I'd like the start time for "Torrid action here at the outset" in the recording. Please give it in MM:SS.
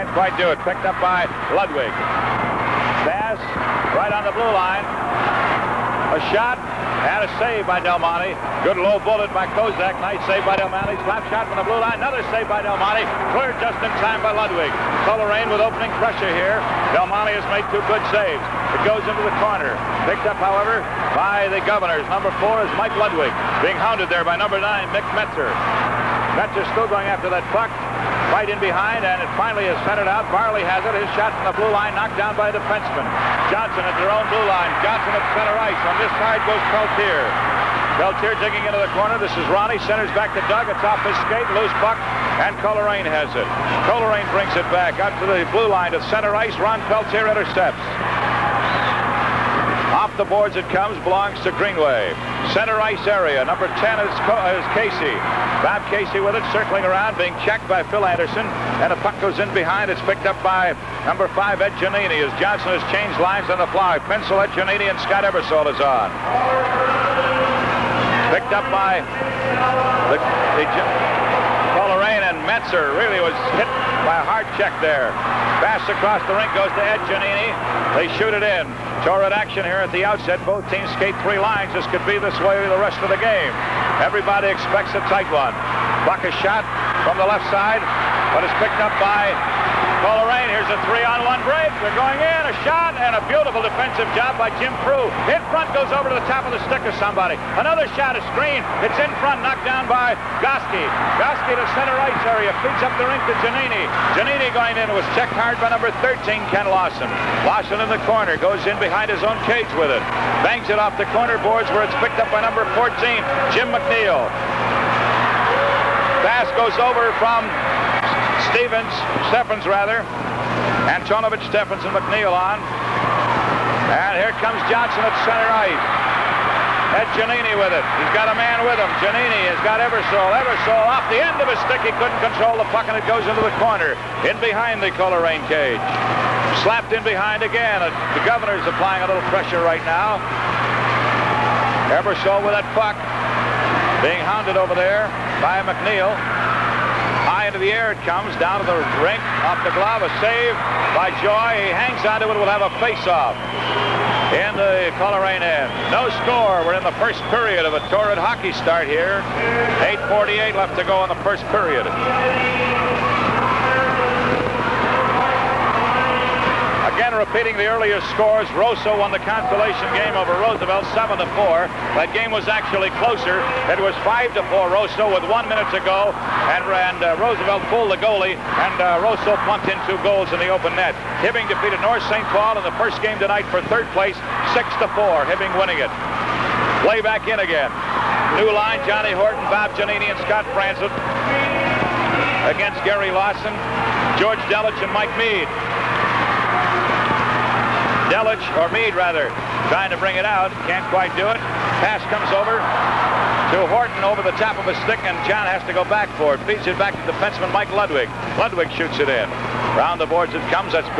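01:19.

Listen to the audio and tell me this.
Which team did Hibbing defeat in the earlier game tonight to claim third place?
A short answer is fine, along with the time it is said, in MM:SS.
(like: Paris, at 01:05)
North St. Paul, at 03:01.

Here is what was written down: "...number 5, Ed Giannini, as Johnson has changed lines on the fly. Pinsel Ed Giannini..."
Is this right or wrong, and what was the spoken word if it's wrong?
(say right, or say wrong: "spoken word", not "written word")
right.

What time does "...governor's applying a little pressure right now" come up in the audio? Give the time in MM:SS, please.
02:18.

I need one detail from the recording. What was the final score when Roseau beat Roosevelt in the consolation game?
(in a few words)
7 to 4.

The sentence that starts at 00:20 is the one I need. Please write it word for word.
Picked up, however, by the Governors.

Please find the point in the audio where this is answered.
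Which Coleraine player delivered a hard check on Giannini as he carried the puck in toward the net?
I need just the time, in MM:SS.
01:46.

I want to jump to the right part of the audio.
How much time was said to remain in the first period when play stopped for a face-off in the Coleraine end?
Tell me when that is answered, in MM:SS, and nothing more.
02:39.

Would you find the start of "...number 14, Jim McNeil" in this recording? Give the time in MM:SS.
01:52.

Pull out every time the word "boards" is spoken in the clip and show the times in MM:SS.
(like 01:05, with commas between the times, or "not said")
00:50, 01:51, 03:30.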